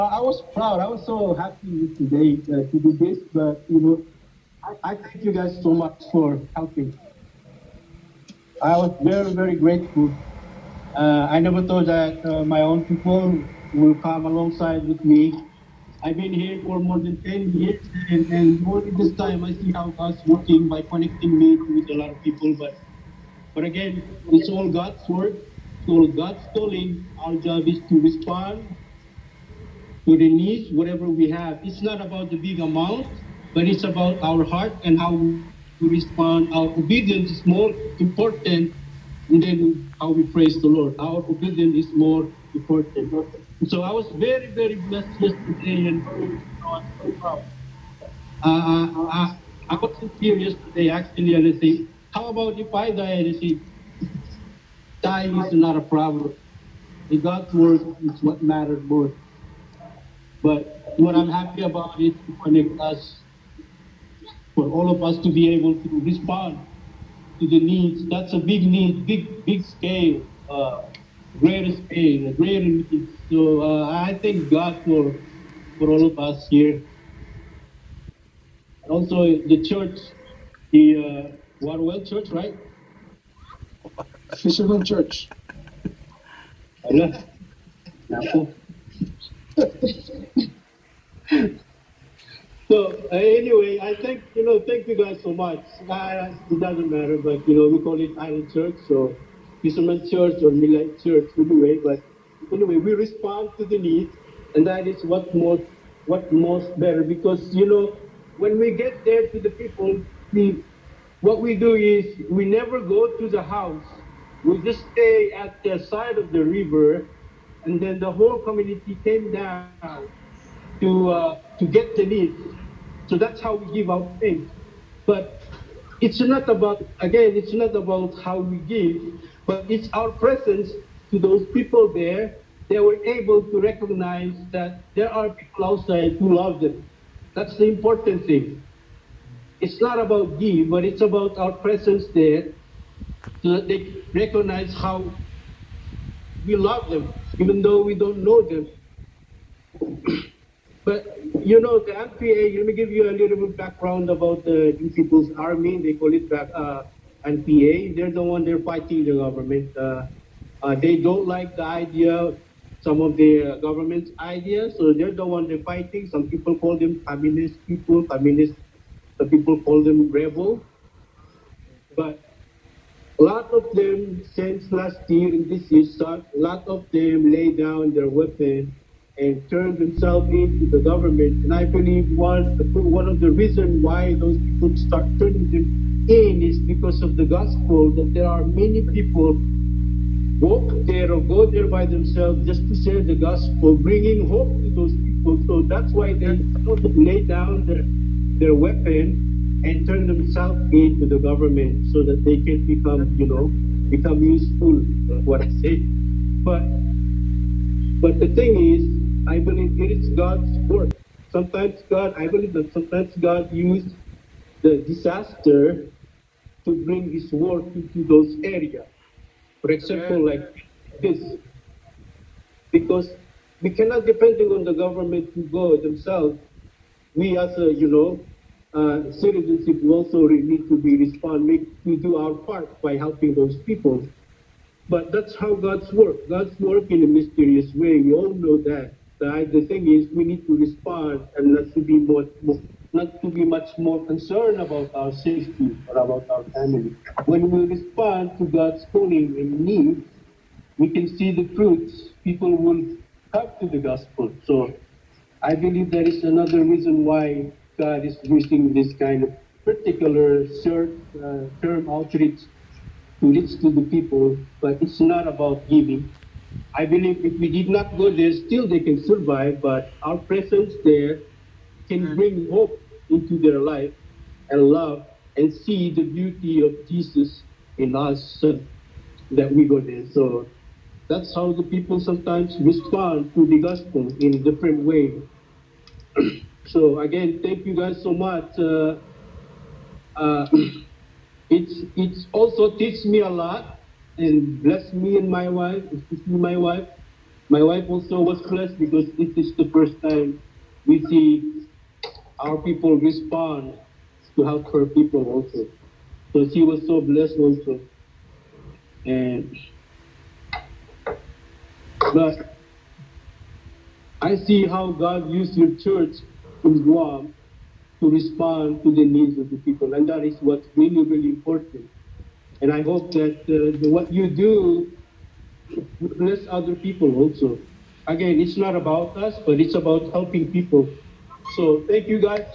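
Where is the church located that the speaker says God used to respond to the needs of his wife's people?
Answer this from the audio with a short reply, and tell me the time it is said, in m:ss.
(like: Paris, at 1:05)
Guam, at 5:16.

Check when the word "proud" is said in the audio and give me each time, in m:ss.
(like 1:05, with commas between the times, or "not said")
0:00.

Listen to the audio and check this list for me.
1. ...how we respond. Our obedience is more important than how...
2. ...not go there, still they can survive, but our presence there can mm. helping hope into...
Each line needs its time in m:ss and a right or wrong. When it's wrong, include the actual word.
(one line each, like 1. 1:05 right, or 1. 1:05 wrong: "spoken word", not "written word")
1. 0:34 right
2. 4:27 wrong: "bring", not "helping".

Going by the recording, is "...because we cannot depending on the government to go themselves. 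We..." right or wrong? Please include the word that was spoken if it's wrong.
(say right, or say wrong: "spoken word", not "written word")
right.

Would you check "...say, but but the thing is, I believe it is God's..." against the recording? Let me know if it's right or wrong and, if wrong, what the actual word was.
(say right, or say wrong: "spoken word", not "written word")
right.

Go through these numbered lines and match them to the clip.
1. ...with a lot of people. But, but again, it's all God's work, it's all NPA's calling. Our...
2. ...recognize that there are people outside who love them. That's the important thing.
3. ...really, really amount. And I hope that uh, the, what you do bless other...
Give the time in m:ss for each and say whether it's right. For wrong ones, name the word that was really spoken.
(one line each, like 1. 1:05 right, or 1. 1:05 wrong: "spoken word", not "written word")
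1. 0:21 wrong: "God", not "NPA"
2. 2:13 right
3. 5:20 wrong: "important", not "amount".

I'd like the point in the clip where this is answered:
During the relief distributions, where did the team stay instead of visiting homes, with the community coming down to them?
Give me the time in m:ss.
1:55.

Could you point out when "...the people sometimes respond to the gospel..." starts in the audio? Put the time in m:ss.
4:41.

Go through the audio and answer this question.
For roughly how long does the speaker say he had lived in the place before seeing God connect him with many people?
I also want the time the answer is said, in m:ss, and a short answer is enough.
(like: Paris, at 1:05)
more than 10 years, at 0:16.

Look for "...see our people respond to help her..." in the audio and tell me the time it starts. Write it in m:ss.
5:01.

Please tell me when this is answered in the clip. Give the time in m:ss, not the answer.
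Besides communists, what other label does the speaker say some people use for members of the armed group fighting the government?
2:50.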